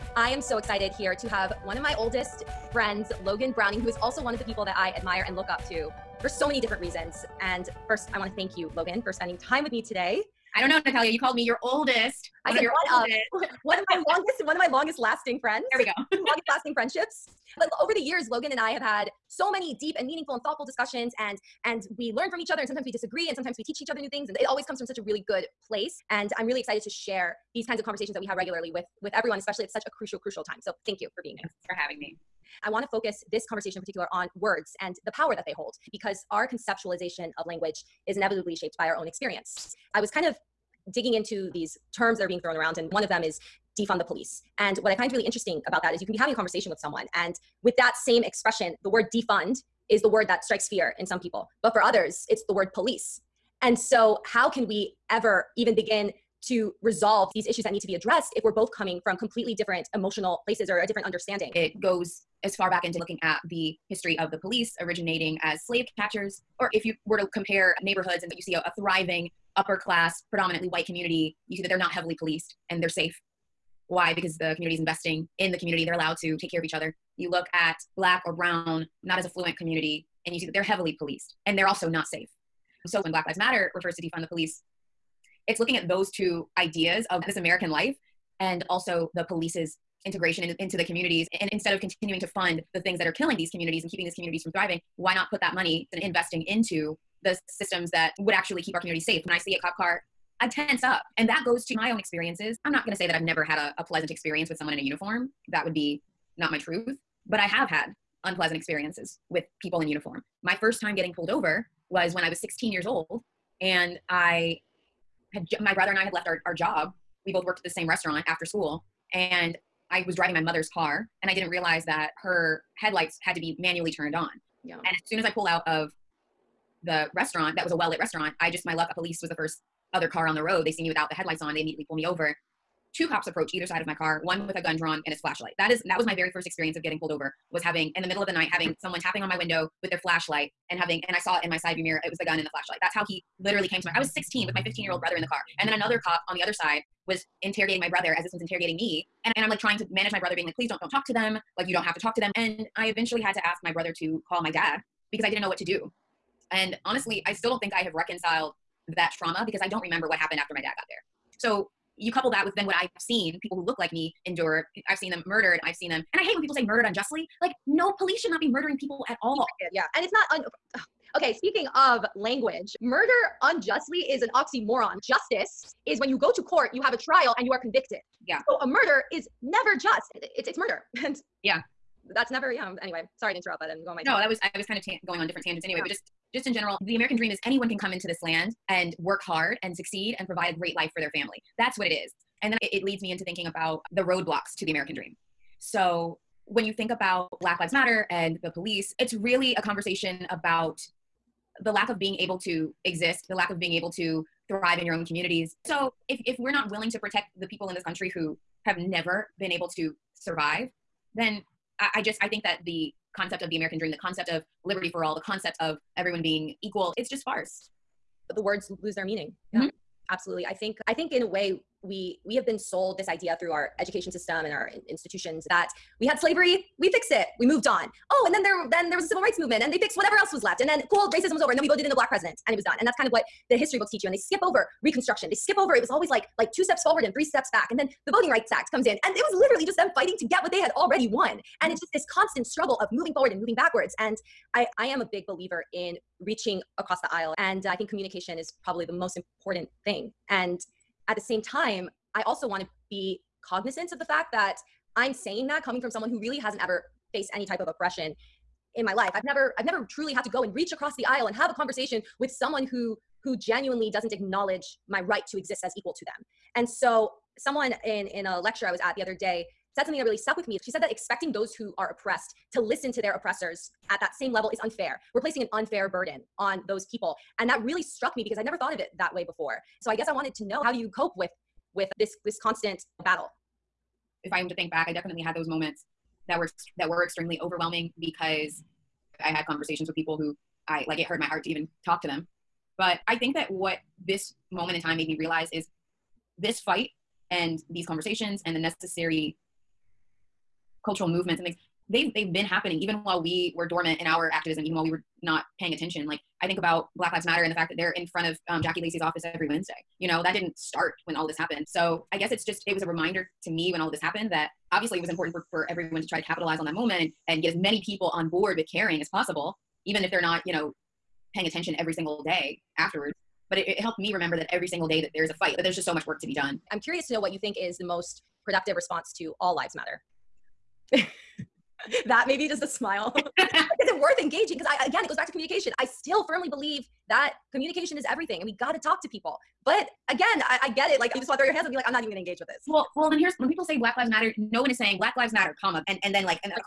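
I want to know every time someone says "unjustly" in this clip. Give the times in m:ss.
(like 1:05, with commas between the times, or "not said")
2:46, 2:53.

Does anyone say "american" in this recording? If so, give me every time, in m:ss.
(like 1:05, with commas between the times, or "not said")
1:27, 3:06, 3:14, 3:33.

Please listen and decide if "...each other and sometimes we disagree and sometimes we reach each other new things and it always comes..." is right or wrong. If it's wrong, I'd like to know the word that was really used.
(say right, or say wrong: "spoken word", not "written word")
wrong: "teach", not "reach".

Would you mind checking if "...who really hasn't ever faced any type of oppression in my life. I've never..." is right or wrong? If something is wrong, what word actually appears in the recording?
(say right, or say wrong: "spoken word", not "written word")
right.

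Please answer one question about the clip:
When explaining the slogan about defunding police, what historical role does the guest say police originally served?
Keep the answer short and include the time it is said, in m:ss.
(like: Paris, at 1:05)
slave catchers, at 1:05.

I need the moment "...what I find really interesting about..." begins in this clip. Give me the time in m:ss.
0:44.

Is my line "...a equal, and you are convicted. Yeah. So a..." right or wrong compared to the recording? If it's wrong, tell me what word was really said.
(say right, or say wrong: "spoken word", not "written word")
wrong: "trial", not "equal".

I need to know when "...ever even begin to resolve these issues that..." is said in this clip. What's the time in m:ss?
0:55.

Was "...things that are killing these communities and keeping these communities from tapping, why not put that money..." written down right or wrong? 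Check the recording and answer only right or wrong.
wrong.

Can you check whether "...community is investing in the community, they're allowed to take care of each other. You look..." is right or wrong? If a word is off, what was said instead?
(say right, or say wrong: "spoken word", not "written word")
right.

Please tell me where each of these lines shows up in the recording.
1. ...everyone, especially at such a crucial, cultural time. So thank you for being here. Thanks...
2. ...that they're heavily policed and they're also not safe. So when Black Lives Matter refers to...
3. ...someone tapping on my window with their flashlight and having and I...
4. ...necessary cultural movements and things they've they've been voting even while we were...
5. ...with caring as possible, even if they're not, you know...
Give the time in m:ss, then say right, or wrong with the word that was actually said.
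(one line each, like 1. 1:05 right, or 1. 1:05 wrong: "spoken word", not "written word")
1. 0:29 wrong: "crucial", not "cultural"
2. 1:20 right
3. 2:18 right
4. 4:58 wrong: "happening", not "voting"
5. 5:18 right.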